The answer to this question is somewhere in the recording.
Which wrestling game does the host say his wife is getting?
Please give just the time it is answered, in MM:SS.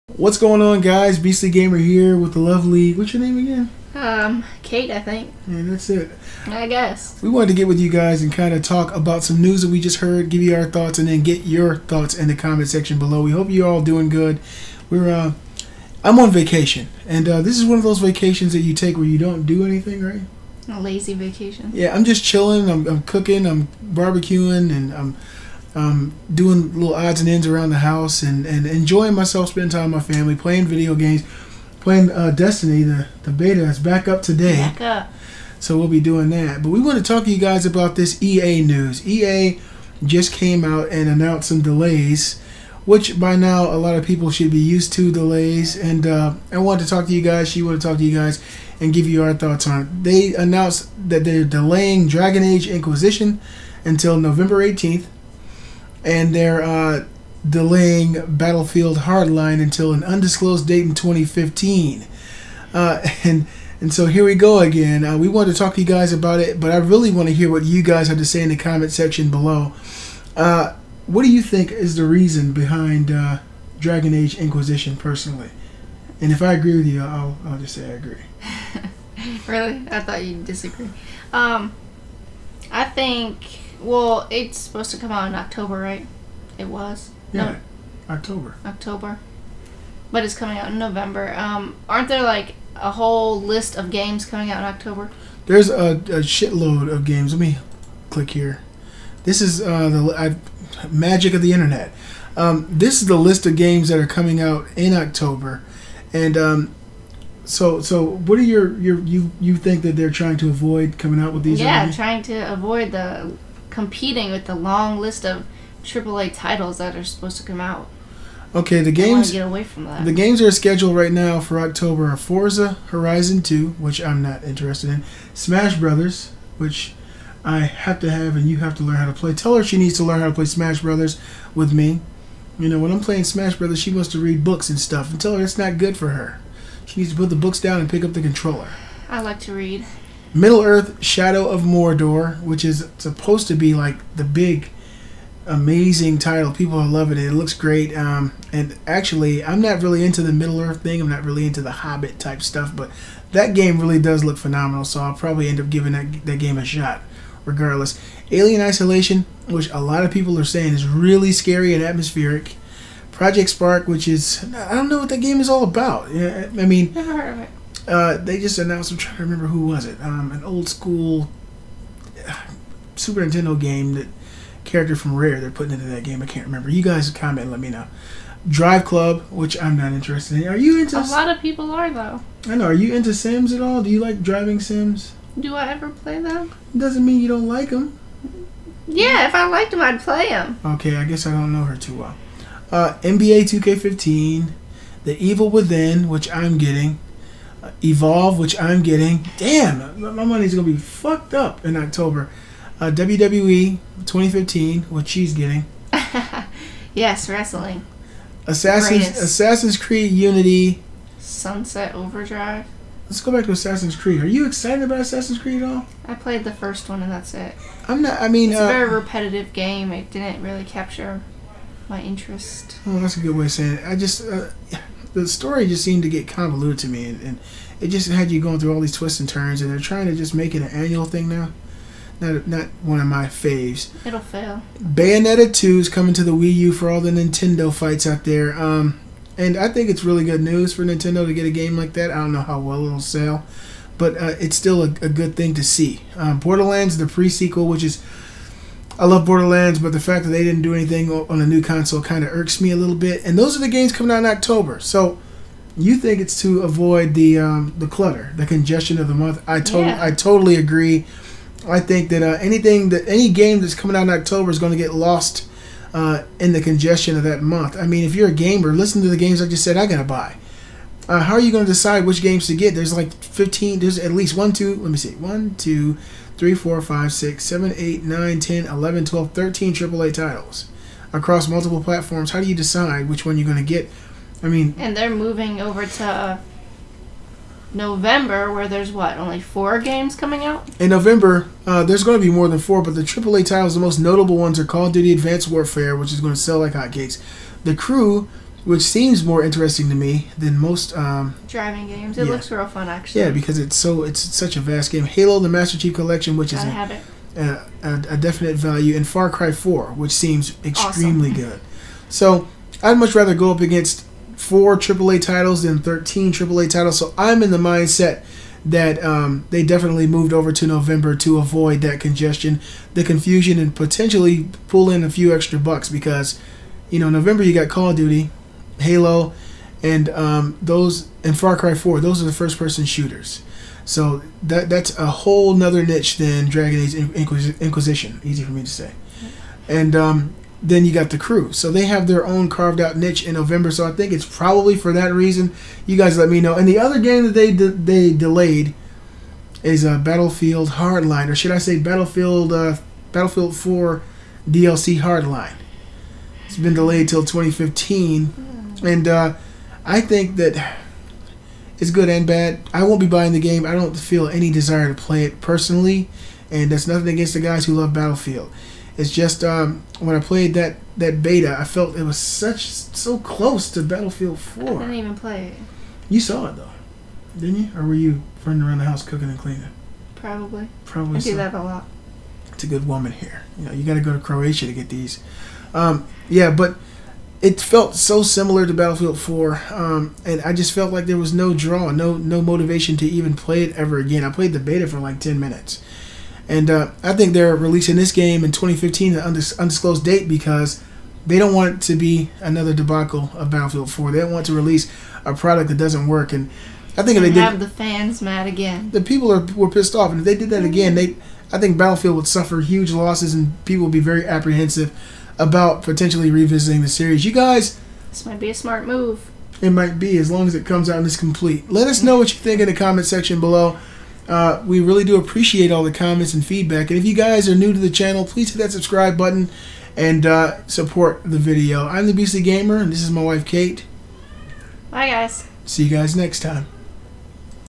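03:22.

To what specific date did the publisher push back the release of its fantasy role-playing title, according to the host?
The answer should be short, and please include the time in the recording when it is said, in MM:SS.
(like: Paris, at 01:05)
November 18th, at 00:54.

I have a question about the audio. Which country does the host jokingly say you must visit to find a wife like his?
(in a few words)
Croatia.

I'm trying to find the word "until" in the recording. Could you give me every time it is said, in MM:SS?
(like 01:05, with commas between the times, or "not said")
00:53, 00:59.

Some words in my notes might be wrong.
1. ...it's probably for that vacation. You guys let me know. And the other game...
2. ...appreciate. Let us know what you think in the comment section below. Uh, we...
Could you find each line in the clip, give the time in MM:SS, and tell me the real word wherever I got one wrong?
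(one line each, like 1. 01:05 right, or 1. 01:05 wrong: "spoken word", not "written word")
1. 05:44 wrong: "reason", not "vacation"
2. 07:01 wrong: "complete", not "appreciate".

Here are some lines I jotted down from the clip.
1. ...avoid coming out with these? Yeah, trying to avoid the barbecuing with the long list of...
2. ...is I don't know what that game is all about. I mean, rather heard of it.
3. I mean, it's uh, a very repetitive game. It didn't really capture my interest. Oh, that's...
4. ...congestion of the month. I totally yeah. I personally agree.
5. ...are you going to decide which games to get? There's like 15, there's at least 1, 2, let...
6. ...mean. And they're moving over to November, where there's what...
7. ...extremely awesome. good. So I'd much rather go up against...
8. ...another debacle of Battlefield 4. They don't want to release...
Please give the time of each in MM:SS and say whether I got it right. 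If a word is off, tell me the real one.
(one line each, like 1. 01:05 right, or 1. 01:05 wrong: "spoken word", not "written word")
1. 01:50 wrong: "competing", not "barbecuing"
2. 02:44 wrong: "never", not "rather"
3. 03:38 right
4. 04:18 wrong: "totally", not "personally"
5. 04:31 right
6. 04:44 right
7. 05:10 right
8. 06:42 right.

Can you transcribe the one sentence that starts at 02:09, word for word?
Tell her she needs to learn how to play Smash Brothers with me.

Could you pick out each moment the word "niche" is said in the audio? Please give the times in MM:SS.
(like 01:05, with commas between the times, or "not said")
05:35, 05:42.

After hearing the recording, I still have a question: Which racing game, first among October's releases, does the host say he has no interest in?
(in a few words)
Forza Horizon 2.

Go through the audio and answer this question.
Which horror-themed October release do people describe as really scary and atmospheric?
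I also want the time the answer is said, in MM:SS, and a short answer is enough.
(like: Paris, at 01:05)
Alien Isolation, at 02:38.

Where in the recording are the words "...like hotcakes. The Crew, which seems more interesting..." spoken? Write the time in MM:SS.
04:56.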